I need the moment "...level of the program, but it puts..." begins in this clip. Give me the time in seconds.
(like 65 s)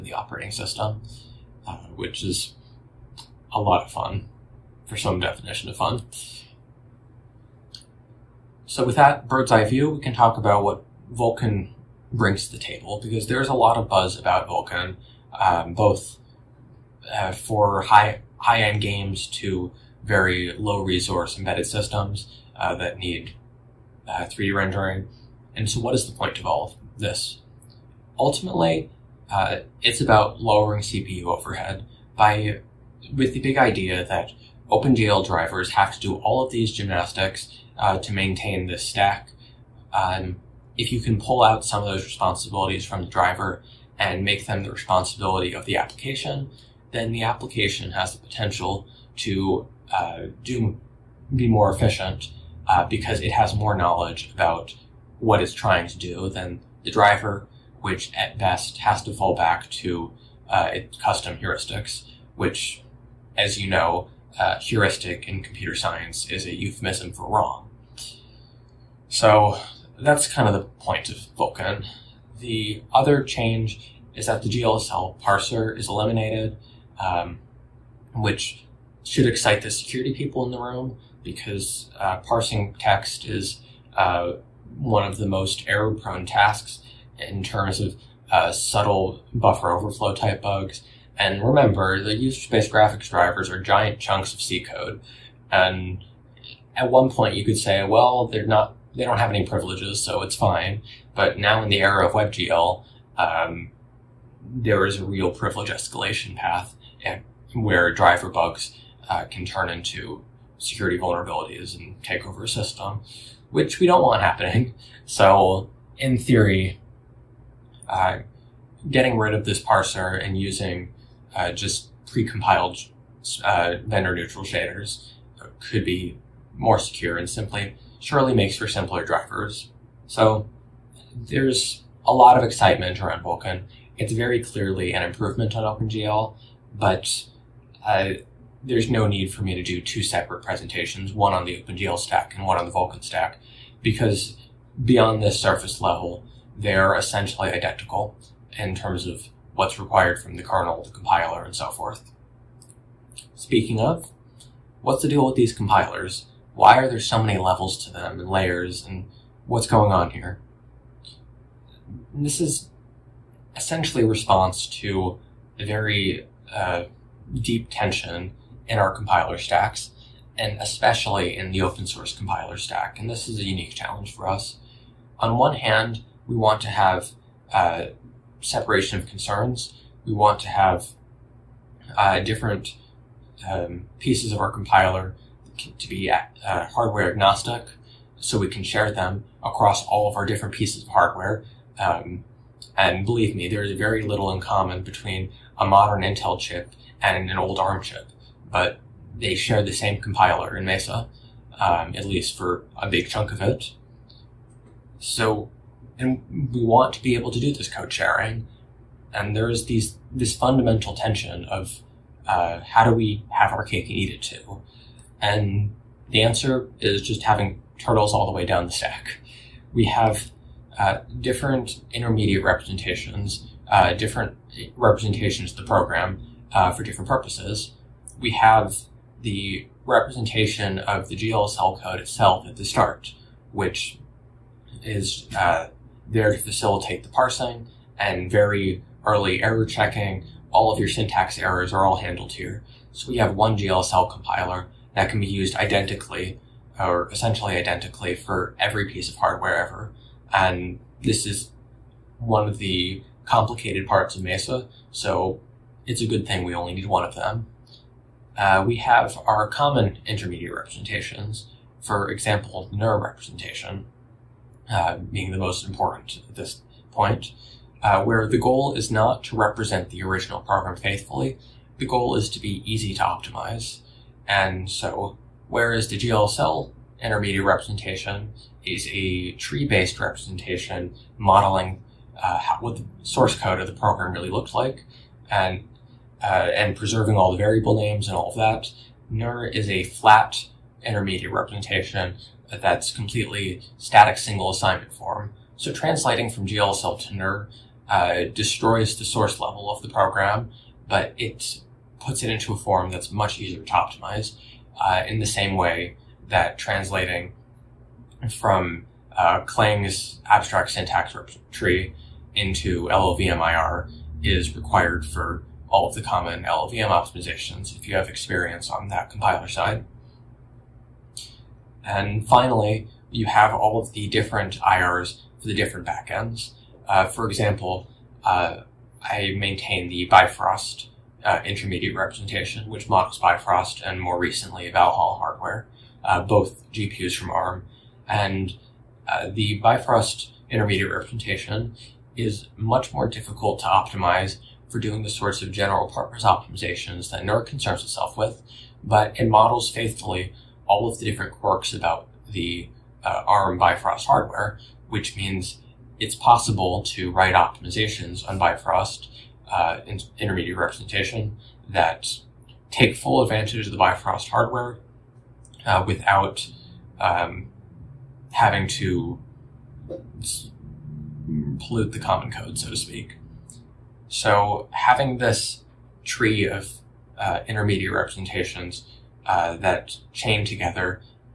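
299 s.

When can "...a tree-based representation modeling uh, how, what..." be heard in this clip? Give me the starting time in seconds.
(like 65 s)
278 s.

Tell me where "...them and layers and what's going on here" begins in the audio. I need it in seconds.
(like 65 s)
157 s.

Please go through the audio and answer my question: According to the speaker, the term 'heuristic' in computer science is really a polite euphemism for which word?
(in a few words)
wrong.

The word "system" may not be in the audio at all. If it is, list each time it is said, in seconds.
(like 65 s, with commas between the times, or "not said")
0 s, 21 s, 112 s.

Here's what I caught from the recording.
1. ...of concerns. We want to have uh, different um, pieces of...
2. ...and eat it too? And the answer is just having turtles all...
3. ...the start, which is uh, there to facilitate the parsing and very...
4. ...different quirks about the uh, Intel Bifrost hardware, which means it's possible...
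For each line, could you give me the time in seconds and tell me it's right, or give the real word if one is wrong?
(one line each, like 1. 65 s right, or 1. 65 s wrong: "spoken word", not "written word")
1. 178 s right
2. 213 s right
3. 232 s right
4. 351 s wrong: "ARM", not "Intel".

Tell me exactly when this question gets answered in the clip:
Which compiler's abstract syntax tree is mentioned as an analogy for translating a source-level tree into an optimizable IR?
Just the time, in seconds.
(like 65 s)
309 s.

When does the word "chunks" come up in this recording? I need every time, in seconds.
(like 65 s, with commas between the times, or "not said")
93 s, 203 s.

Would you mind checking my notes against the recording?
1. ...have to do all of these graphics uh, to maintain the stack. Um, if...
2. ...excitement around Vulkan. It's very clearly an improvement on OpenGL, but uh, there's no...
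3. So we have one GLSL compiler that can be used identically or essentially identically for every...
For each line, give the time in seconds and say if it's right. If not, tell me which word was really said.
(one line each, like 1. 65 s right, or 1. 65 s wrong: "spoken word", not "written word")
1. 35 s wrong: "gymnastics", not "graphics"
2. 132 s right
3. 242 s right.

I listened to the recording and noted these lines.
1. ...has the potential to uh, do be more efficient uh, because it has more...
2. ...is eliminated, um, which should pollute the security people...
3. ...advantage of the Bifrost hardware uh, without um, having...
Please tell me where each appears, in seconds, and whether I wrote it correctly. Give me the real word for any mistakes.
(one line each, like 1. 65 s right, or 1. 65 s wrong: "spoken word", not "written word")
1. 47 s right
2. 75 s wrong: "excite", not "pollute"
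3. 363 s right.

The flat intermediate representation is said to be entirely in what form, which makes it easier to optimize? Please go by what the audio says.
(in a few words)
static single assignment.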